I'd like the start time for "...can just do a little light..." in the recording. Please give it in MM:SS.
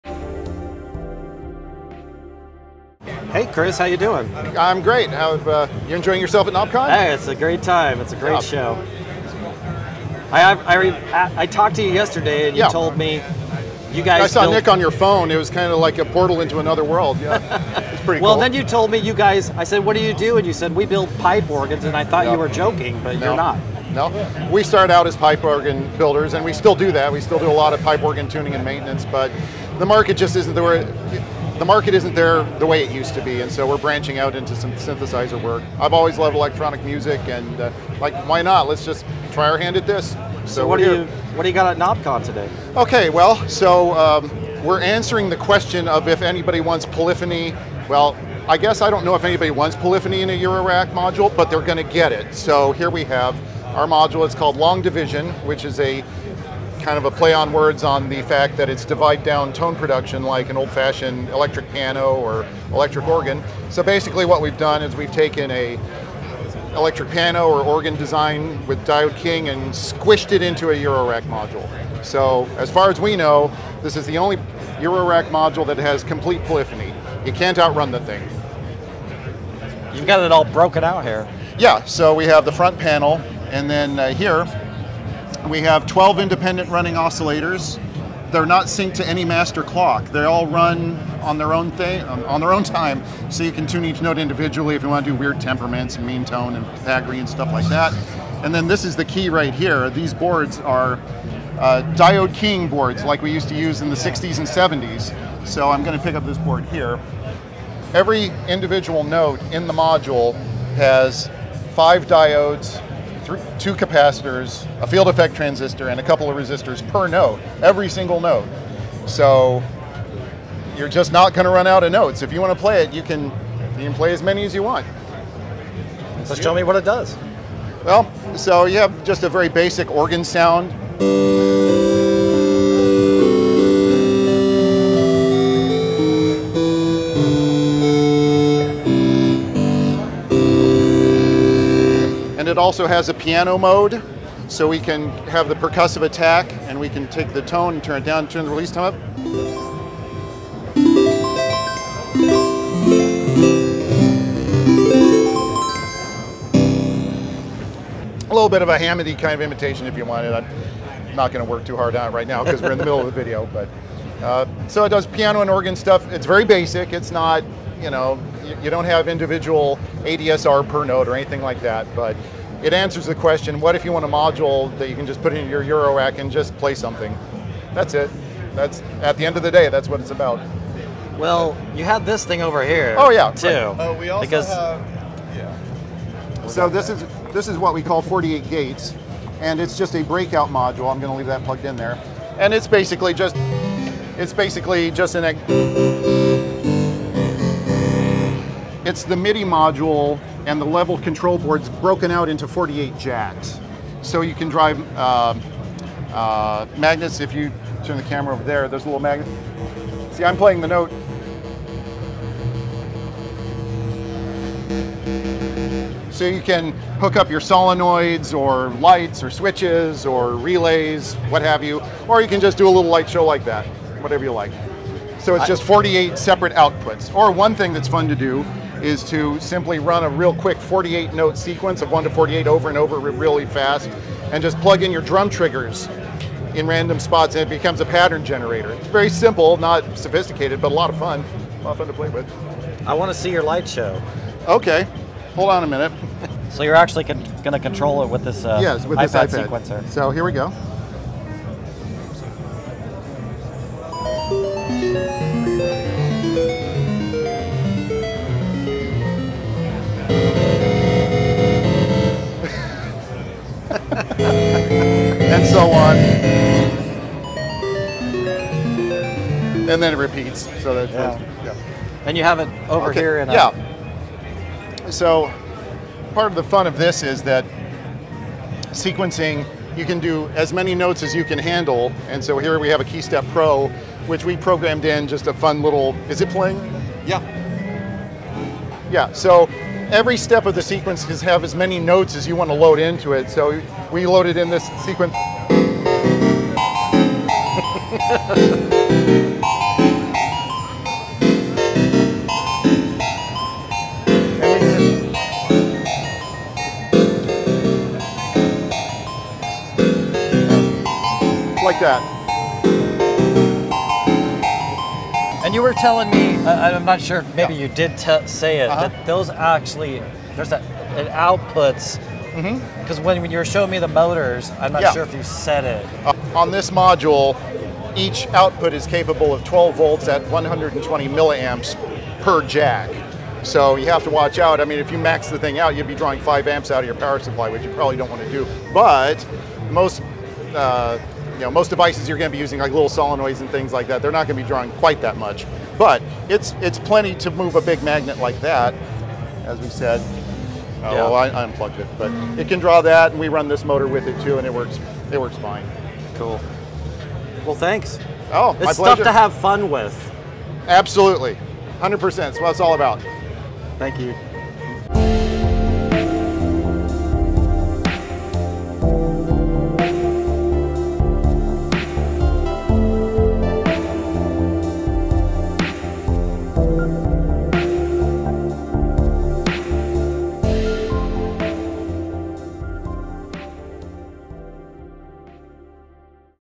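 03:42.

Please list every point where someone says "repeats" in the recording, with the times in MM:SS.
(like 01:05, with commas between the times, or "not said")
04:29.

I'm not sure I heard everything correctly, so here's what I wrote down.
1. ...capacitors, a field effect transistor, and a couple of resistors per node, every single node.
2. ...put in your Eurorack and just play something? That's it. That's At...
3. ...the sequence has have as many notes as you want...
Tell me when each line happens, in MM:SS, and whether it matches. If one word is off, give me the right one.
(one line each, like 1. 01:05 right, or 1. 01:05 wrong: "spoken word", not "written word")
1. 01:53 right
2. 02:55 right
3. 04:50 right.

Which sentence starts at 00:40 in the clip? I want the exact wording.
So, so what do you what do you got at Knobcon today?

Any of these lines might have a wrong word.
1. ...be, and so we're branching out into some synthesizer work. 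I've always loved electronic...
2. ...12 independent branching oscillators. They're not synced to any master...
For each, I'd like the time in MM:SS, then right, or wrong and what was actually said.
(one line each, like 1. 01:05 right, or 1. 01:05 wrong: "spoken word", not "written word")
1. 00:33 right
2. 01:25 wrong: "running", not "branching".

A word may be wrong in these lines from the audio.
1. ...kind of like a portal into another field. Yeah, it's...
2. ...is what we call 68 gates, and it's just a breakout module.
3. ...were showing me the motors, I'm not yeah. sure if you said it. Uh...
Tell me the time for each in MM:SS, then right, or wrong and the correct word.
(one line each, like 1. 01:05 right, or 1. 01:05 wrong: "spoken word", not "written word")
1. 00:15 wrong: "world", not "field"
2. 03:07 wrong: "48", not "68"
3. 05:23 right.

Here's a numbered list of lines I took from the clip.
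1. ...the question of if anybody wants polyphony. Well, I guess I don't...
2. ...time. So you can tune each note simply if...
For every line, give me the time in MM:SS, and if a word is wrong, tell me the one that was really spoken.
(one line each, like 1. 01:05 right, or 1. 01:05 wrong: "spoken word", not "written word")
1. 00:45 right
2. 01:32 wrong: "individually", not "simply".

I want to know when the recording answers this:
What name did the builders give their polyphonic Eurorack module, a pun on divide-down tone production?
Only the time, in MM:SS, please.
00:54.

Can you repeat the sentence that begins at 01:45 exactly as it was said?
So I'm going to pick up this board here.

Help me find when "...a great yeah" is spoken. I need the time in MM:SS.
00:08.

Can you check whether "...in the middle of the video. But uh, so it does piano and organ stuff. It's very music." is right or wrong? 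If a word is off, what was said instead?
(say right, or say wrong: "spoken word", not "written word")
wrong: "basic", not "music".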